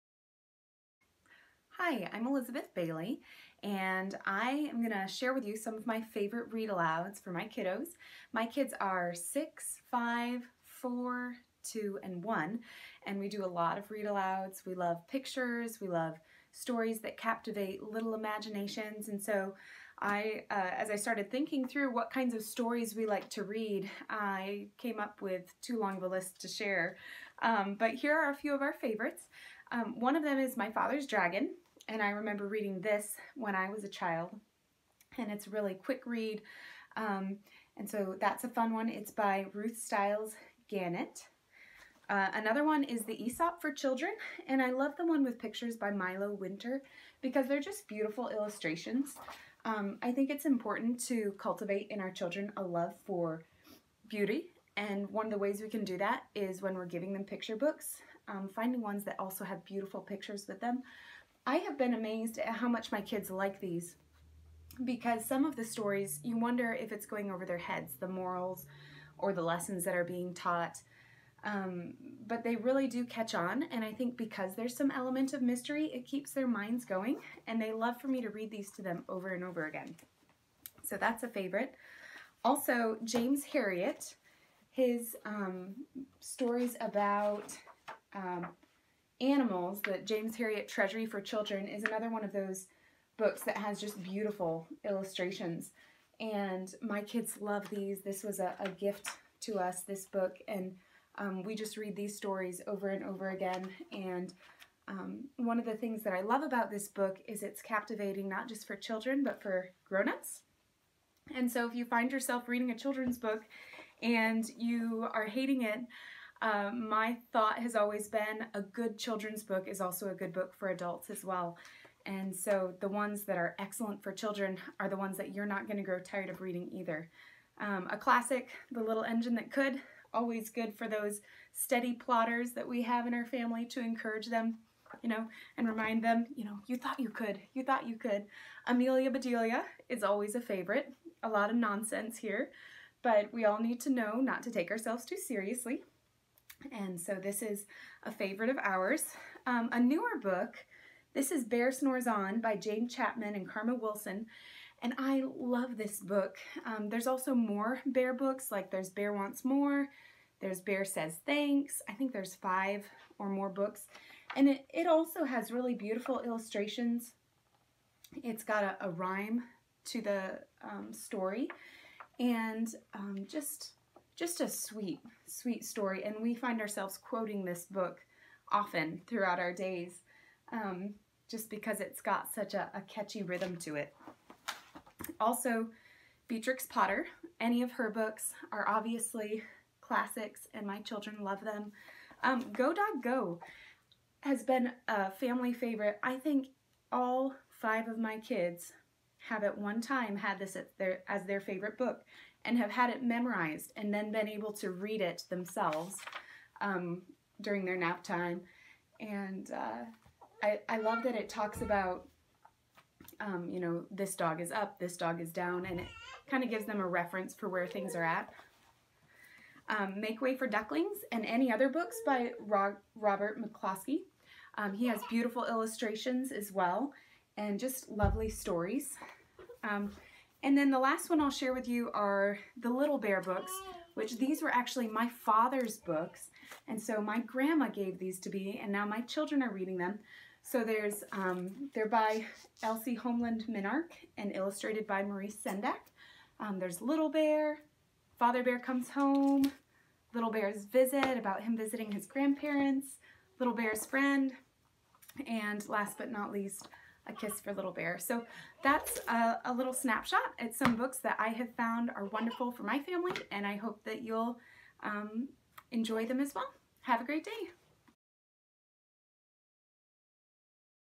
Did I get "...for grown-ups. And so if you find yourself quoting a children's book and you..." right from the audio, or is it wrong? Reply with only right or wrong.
wrong.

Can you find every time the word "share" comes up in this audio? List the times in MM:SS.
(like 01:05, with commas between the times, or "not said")
00:05, 00:26, 03:51.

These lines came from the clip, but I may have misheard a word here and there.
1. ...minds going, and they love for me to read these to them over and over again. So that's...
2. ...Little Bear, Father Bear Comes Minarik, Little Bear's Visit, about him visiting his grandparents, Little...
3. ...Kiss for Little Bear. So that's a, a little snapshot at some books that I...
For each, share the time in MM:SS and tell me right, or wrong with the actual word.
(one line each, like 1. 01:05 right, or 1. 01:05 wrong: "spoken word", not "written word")
1. 01:16 right
2. 04:06 wrong: "Home", not "Minarik"
3. 04:17 right.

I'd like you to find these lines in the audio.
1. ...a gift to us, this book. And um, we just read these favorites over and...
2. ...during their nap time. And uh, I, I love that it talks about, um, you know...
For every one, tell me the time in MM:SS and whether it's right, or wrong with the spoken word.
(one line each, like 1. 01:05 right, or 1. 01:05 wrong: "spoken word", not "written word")
1. 01:38 wrong: "stories", not "favorites"
2. 03:27 right.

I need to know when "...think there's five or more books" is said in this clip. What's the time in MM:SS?
02:41.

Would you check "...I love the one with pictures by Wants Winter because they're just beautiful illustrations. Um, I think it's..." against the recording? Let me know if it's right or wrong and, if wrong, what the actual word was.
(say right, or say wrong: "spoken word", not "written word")
wrong: "Milo", not "Wants".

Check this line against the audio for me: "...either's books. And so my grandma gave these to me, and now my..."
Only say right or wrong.
wrong.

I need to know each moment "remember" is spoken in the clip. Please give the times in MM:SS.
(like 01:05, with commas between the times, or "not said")
00:32.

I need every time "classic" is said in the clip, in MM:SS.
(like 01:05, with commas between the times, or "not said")
02:07, 03:09.